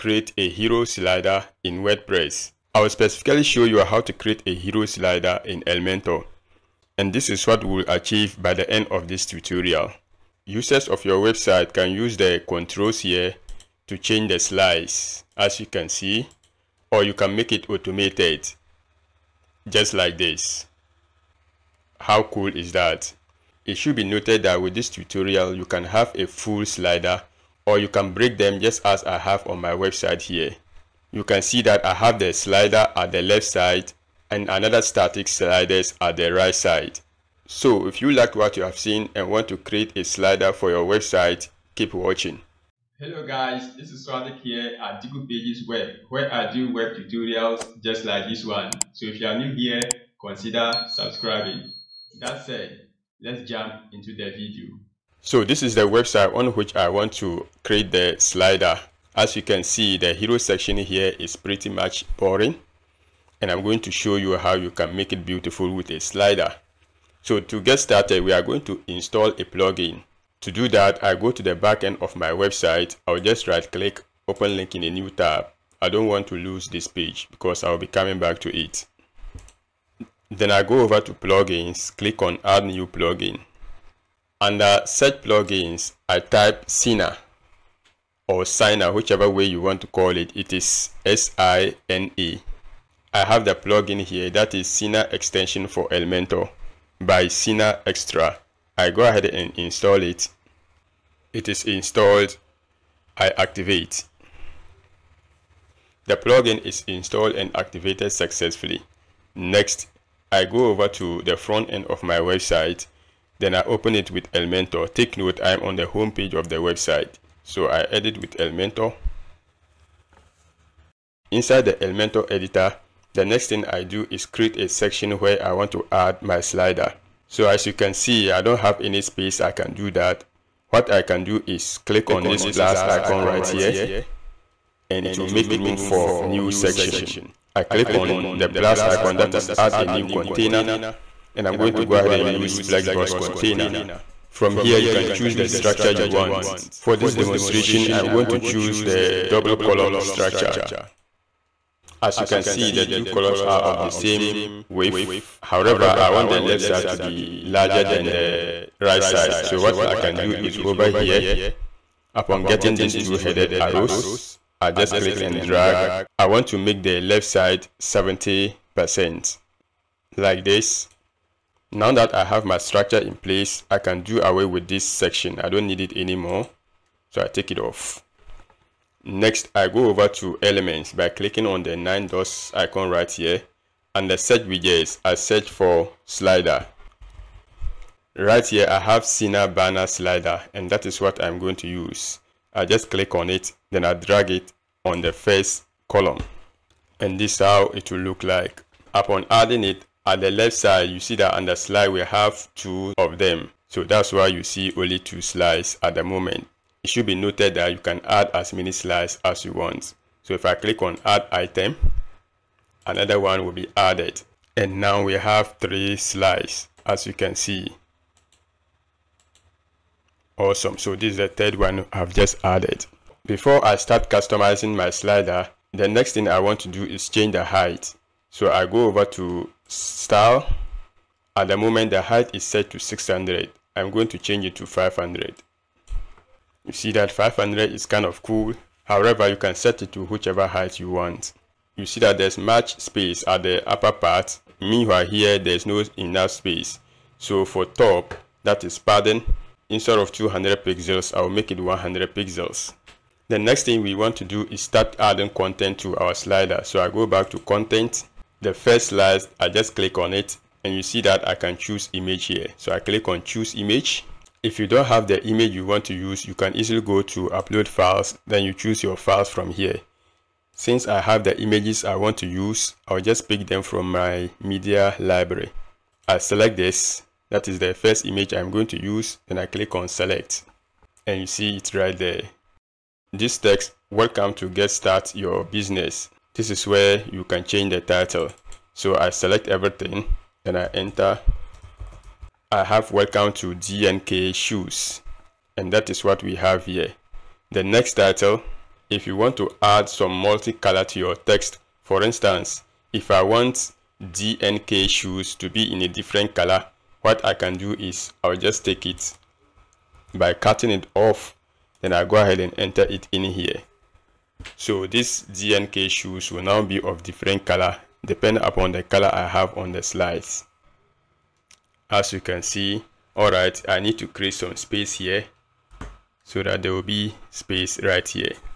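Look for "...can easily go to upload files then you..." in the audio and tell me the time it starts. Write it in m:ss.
4:26.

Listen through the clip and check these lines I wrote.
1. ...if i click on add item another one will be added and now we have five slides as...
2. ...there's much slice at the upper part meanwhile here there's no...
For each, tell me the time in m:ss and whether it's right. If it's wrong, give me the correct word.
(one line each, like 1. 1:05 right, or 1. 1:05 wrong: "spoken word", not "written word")
1. 3:30 wrong: "three", not "five"
2. 4:02 wrong: "space", not "slice".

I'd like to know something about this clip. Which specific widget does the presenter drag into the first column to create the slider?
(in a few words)
Sina banner slider.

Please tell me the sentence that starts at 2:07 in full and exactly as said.
So as you can see, I don't have any space I can do that.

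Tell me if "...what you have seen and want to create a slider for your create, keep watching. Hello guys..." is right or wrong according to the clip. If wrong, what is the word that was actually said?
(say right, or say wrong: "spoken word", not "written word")
wrong: "website", not "create".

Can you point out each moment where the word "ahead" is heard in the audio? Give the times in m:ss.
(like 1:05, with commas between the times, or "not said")
1:39, 2:21, 5:12.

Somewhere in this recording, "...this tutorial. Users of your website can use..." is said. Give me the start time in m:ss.
0:09.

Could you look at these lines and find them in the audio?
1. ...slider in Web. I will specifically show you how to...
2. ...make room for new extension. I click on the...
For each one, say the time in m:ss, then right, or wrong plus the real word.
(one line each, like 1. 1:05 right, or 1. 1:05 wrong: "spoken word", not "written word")
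1. 0:00 wrong: "WordPress", not "Web"
2. 2:15 wrong: "section", not "extension".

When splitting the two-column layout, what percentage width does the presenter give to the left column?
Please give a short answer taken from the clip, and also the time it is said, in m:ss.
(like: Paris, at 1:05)
70%, at 2:47.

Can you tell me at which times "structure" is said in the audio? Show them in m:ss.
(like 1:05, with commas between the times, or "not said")
2:25, 2:29, 2:52.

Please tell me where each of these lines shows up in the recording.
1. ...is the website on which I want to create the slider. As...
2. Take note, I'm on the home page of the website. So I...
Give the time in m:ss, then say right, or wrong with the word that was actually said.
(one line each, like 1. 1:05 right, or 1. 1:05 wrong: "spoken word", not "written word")
1. 0:55 right
2. 1:54 right.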